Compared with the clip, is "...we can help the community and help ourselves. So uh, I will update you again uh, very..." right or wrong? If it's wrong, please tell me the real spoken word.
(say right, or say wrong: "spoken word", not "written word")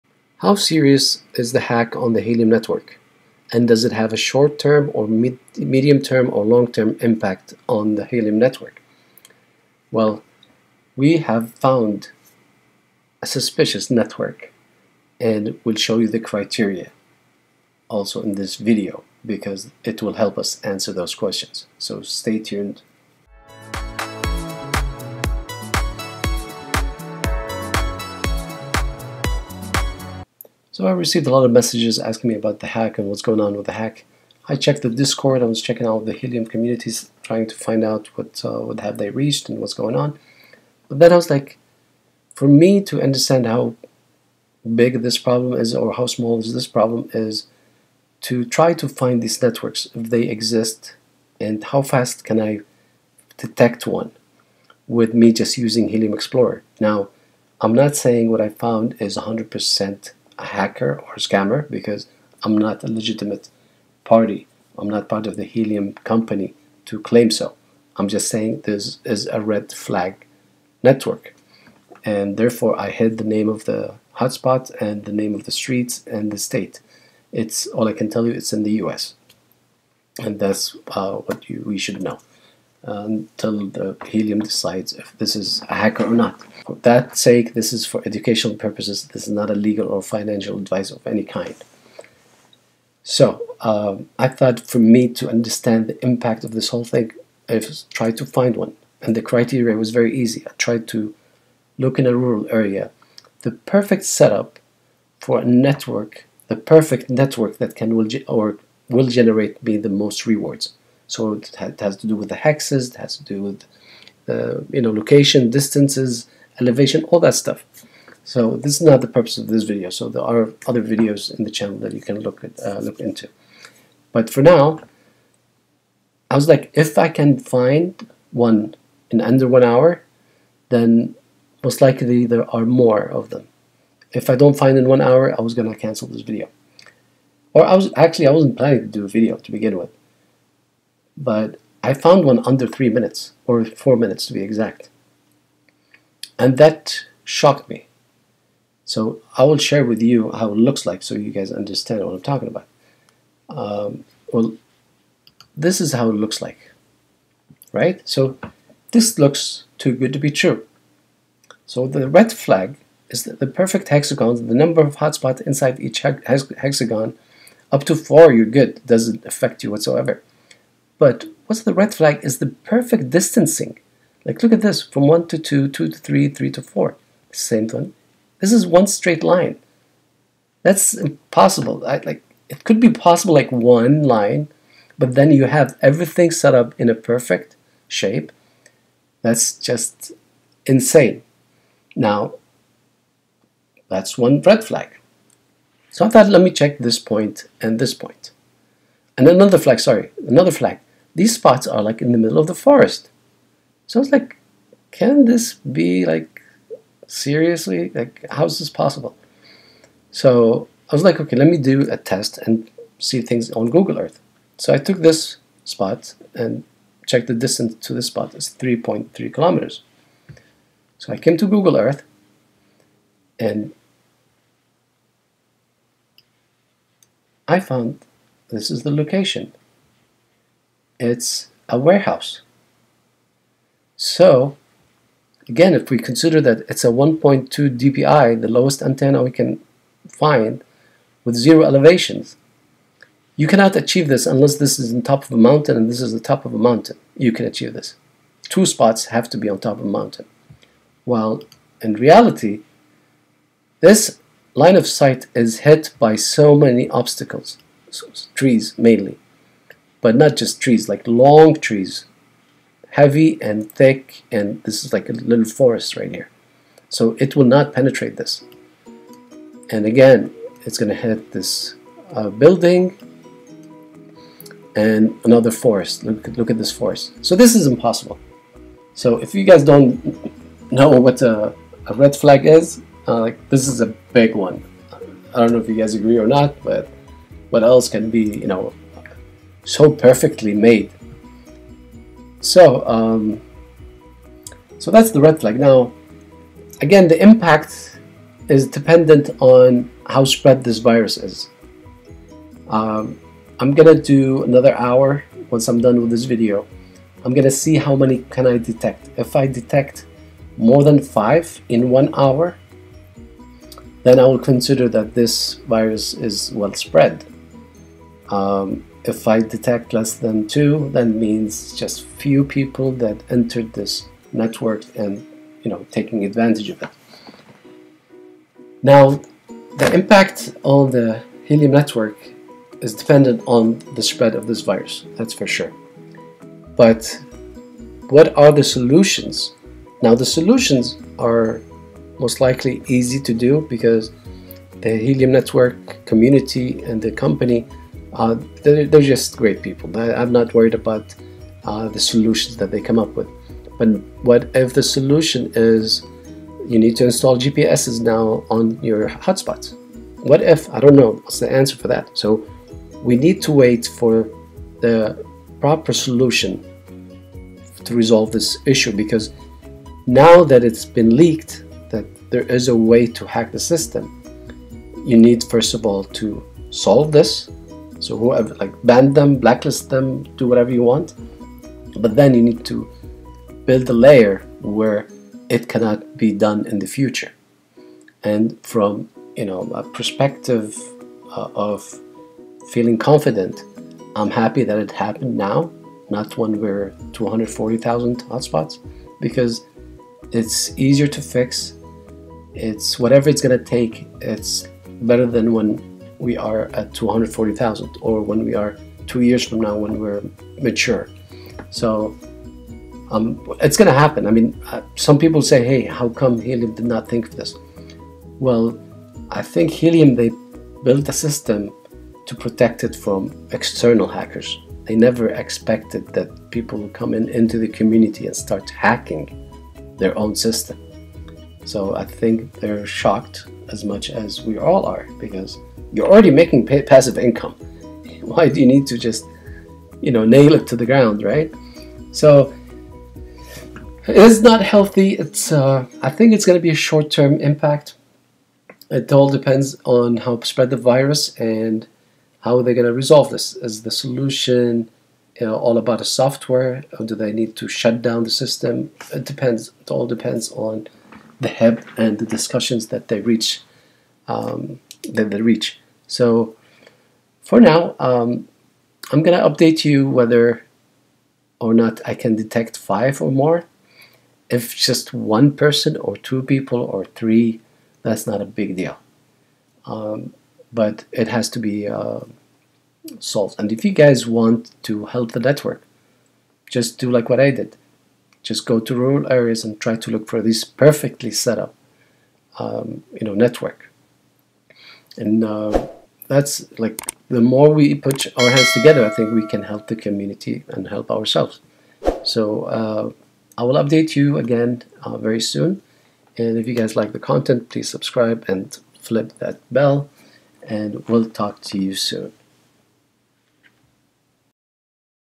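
right.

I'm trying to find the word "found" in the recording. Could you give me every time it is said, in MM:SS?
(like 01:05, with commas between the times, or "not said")
00:11, 00:58, 02:21, 03:47.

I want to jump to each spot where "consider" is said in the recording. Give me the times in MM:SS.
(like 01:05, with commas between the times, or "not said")
03:55, 05:14.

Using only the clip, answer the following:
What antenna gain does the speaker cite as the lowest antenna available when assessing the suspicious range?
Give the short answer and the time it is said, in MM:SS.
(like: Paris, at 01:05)
1.2 dBi, at 03:56.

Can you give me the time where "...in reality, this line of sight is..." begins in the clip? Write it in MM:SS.
04:11.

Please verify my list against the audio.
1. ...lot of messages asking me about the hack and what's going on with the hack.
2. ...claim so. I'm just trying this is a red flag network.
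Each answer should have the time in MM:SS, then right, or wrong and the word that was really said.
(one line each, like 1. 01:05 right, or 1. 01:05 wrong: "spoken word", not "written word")
1. 00:31 right
2. 01:06 wrong: "saying", not "trying".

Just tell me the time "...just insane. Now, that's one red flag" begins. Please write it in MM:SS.
03:09.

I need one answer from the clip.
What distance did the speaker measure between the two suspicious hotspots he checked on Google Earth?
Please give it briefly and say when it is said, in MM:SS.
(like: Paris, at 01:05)
3.3 kilometers, at 03:38.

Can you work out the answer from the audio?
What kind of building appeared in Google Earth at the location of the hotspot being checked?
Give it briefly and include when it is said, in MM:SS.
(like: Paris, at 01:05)
A warehouse, at 03:51.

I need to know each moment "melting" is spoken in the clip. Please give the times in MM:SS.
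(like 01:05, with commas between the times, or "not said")
not said.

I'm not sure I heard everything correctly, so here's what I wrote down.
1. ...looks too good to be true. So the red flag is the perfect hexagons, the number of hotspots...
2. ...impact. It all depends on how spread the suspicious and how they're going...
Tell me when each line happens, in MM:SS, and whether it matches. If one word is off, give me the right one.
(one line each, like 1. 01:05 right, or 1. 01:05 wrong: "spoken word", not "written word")
1. 02:39 right
2. 07:27 wrong: "virus", not "suspicious".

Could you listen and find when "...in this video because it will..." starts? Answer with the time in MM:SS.
00:18.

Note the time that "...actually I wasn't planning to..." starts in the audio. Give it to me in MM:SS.
02:17.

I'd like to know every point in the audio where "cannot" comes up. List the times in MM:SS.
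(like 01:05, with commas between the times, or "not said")
04:03, 06:25.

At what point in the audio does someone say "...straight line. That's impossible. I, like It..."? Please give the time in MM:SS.
02:58.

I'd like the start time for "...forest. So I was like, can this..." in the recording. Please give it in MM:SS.
03:22.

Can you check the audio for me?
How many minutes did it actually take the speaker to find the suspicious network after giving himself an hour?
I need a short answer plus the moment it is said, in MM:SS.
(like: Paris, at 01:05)
4, at 02:23.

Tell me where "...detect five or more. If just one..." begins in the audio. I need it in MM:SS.
07:52.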